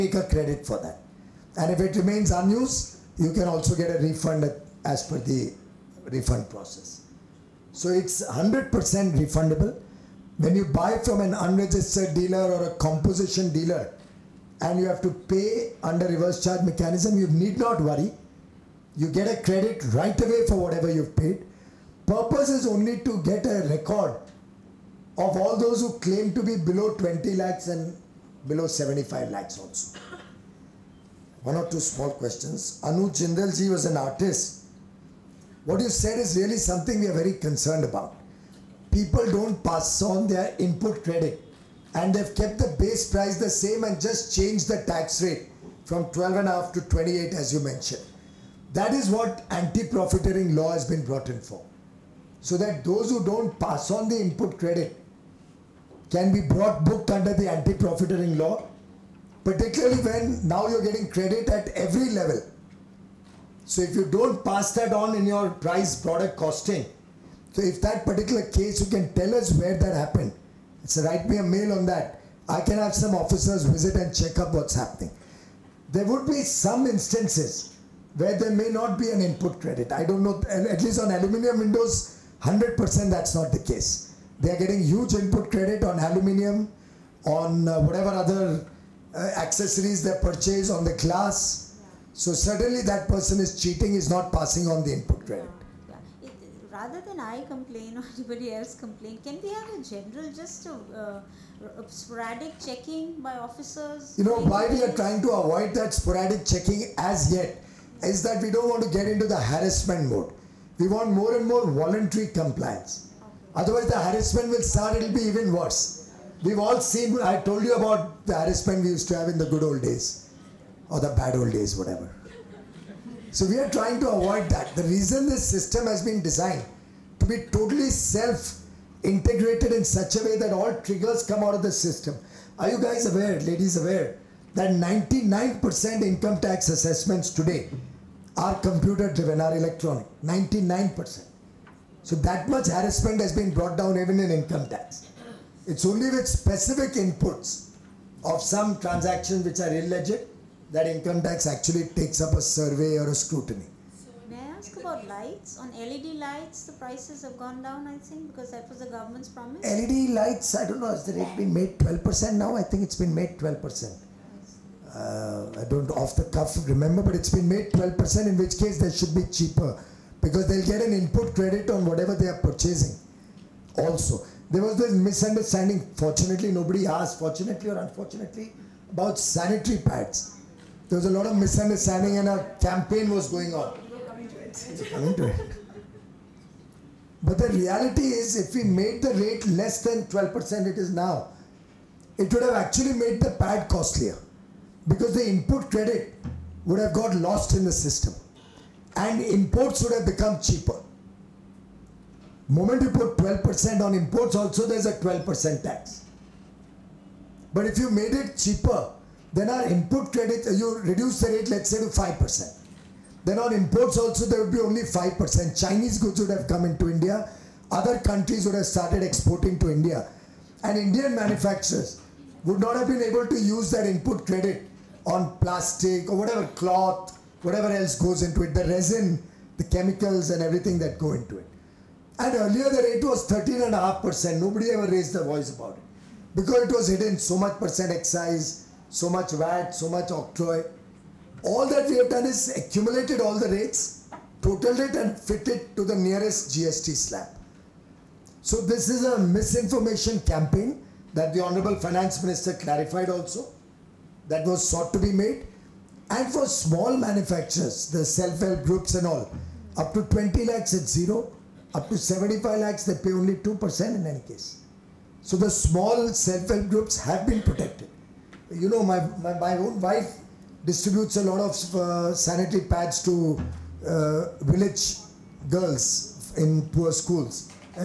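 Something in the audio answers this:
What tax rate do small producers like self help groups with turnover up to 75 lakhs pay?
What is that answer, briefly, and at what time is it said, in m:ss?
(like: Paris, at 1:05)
2%, at 4:23.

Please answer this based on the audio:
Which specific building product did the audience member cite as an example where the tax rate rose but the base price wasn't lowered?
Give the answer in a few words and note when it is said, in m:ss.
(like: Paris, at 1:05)
Aluminium windows, at 1:21.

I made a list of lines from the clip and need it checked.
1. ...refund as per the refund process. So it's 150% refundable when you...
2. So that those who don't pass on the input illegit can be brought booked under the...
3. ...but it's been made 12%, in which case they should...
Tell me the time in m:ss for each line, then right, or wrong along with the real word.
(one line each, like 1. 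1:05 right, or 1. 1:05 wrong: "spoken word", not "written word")
1. 0:04 wrong: "100", not "150"
2. 0:52 wrong: "credit", not "illegit"
3. 2:47 right.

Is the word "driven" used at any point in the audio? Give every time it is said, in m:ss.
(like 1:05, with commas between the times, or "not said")
2:19.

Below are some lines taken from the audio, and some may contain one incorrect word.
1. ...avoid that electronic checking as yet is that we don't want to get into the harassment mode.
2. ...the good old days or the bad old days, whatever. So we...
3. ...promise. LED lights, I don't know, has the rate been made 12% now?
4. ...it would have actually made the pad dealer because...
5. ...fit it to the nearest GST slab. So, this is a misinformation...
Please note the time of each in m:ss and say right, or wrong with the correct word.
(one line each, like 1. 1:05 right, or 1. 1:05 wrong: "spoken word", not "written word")
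1. 1:45 wrong: "sporadic", not "electronic"
2. 1:59 right
3. 2:39 right
4. 3:12 wrong: "costlier", not "dealer"
5. 4:05 right.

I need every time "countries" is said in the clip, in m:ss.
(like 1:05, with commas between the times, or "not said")
3:37.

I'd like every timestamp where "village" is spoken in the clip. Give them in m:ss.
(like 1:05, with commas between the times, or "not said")
4:34.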